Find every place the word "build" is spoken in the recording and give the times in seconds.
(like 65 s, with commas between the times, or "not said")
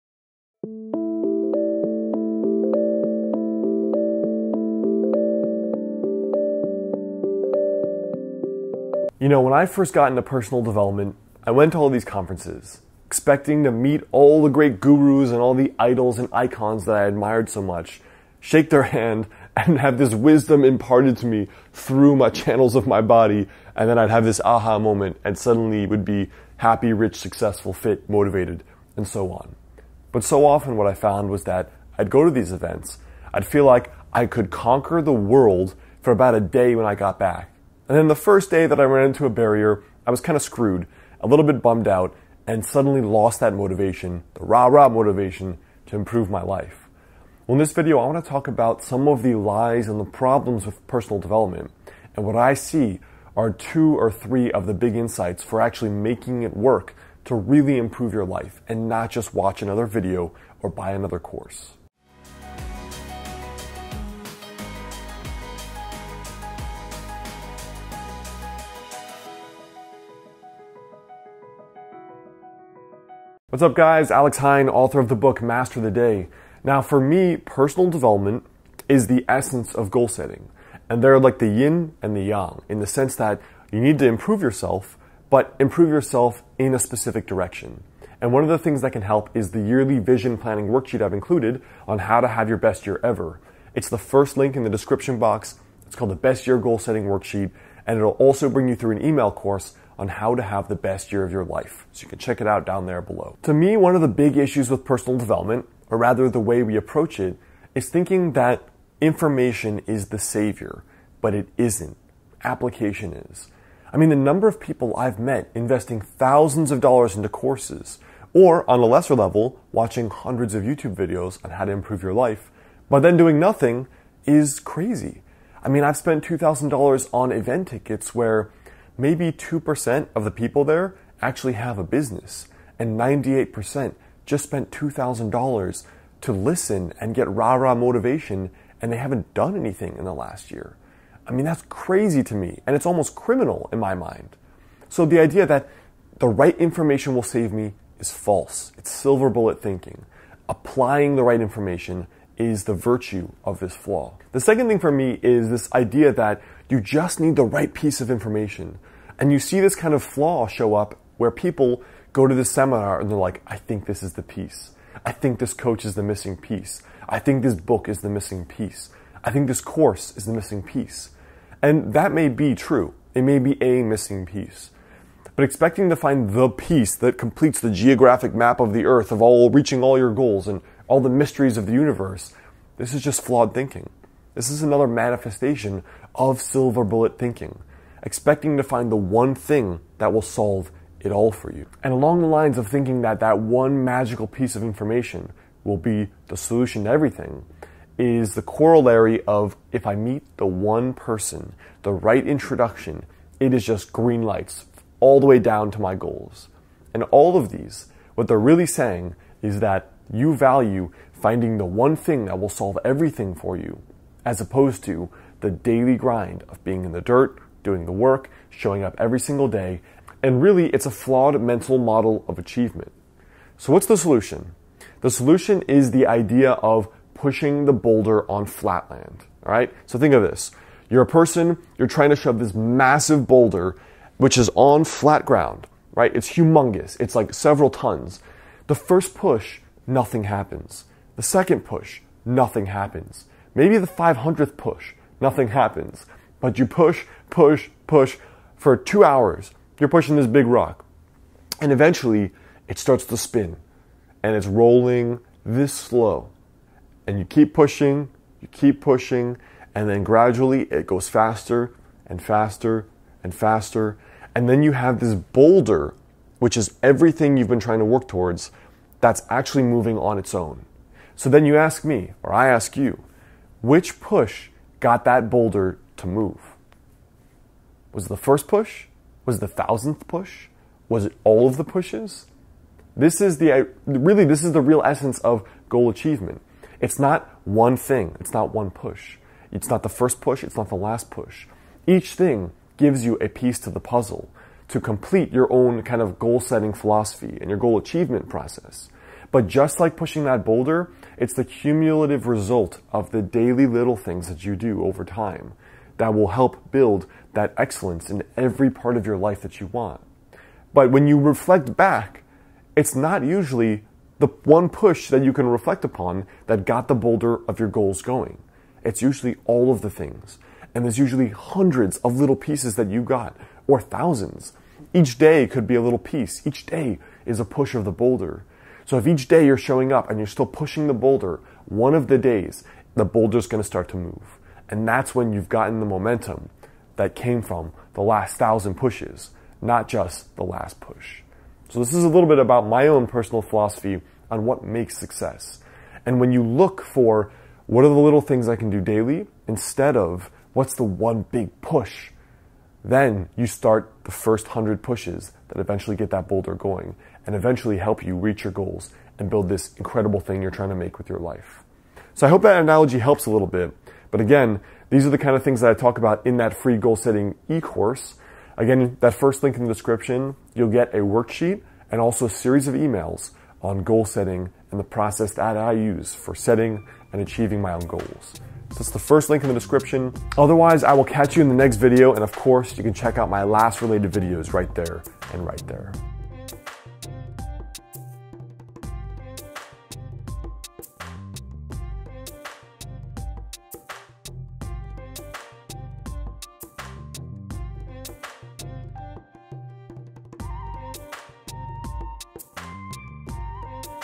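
306 s, 359 s.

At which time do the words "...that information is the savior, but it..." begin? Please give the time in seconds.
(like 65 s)
108 s.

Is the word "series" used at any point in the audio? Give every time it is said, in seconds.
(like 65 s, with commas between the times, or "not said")
372 s.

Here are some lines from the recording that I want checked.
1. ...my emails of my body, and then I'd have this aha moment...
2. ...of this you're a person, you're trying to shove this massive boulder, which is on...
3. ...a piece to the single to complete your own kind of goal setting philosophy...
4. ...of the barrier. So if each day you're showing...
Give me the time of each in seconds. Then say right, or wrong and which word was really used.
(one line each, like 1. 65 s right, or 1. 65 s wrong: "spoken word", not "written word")
1. 22 s wrong: "channels", not "emails"
2. 230 s right
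3. 293 s wrong: "puzzle", not "single"
4. 327 s wrong: "boulder", not "barrier".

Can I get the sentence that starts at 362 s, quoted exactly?
So, I hope that analogy helps a little bit.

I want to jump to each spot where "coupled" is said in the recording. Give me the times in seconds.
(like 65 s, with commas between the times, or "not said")
not said.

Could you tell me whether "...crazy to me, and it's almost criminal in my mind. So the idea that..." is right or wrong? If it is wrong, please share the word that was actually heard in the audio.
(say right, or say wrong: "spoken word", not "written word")
right.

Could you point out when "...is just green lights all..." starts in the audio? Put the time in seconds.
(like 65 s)
203 s.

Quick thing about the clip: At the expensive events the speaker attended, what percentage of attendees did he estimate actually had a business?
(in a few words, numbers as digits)
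2%.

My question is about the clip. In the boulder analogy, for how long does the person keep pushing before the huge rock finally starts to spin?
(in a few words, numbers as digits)
two hours.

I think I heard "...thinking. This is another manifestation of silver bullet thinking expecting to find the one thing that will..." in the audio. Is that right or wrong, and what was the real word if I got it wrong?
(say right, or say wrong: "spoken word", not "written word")
right.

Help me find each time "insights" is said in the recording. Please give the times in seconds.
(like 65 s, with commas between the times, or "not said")
54 s.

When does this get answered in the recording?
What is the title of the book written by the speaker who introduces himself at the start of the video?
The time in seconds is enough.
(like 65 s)
75 s.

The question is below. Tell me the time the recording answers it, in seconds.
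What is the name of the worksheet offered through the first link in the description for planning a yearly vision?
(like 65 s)
96 s.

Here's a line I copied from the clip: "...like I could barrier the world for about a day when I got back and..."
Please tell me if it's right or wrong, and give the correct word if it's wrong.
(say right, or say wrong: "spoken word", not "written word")
wrong: "conquer", not "barrier".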